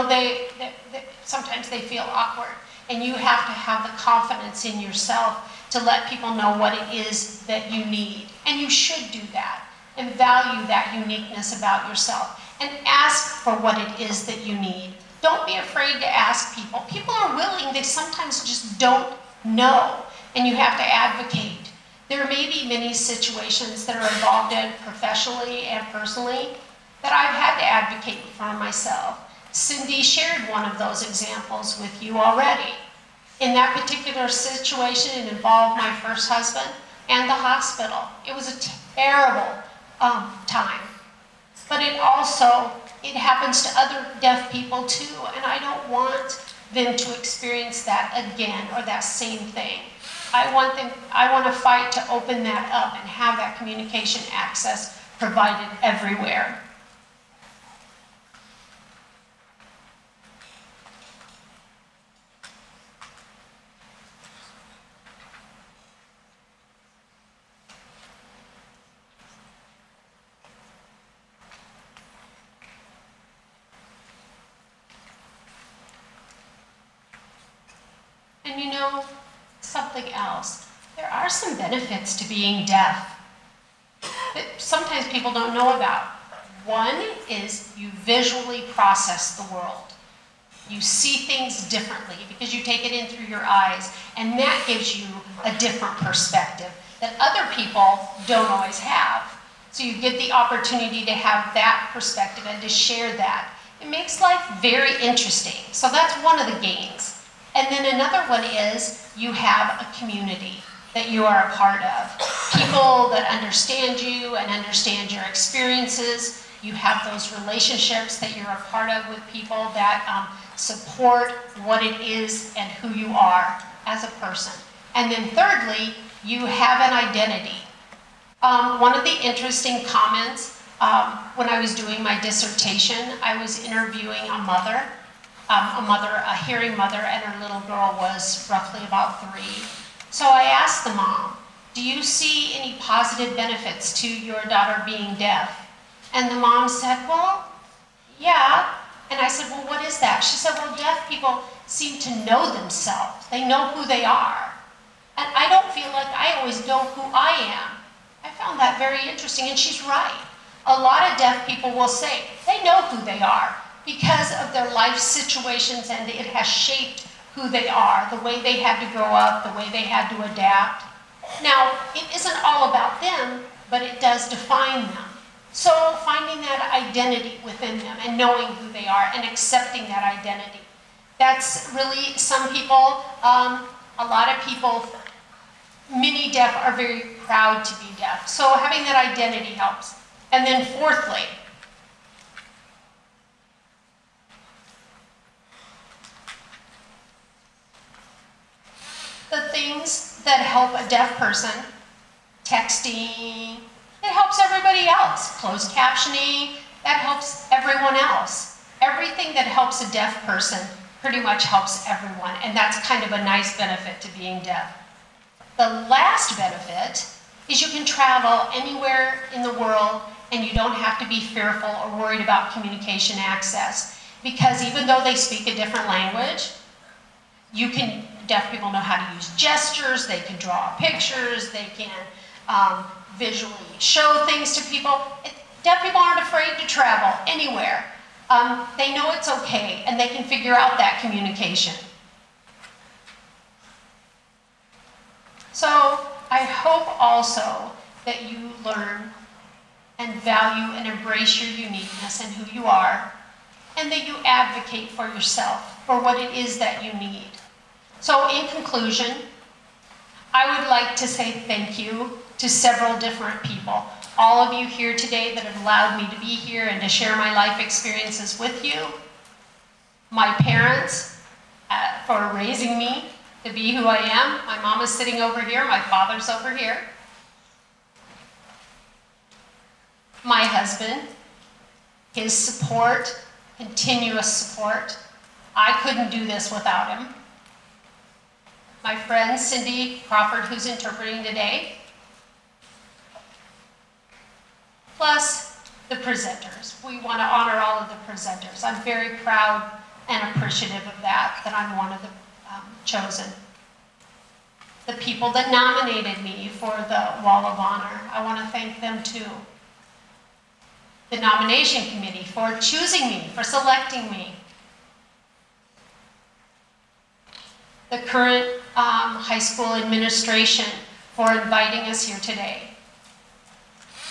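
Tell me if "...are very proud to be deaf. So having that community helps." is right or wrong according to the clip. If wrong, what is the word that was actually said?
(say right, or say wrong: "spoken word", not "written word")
wrong: "identity", not "community".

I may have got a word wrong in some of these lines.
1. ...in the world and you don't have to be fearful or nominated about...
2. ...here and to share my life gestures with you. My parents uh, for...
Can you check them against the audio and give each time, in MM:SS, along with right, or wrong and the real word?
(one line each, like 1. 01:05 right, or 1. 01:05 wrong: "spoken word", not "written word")
1. 03:39 wrong: "worried", not "nominated"
2. 04:26 wrong: "experiences", not "gestures".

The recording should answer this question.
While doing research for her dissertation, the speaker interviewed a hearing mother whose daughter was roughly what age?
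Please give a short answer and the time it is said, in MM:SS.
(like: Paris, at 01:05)
3, at 02:19.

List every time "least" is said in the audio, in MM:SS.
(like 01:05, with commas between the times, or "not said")
not said.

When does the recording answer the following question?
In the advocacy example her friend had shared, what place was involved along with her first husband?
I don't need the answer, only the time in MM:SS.
00:37.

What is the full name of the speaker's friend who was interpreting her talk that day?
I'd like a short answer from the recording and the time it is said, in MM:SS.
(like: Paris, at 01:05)
Cindy Crawford, at 04:49.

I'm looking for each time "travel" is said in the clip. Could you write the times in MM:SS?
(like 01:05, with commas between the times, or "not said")
03:37, 03:56.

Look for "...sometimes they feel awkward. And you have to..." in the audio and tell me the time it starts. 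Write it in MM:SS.
00:01.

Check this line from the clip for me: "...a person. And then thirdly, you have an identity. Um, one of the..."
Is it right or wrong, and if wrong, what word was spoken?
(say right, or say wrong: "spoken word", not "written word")
right.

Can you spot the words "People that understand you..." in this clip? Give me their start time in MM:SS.
01:52.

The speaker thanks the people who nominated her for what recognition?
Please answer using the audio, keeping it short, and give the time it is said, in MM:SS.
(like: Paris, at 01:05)
Wall of Honor, at 05:07.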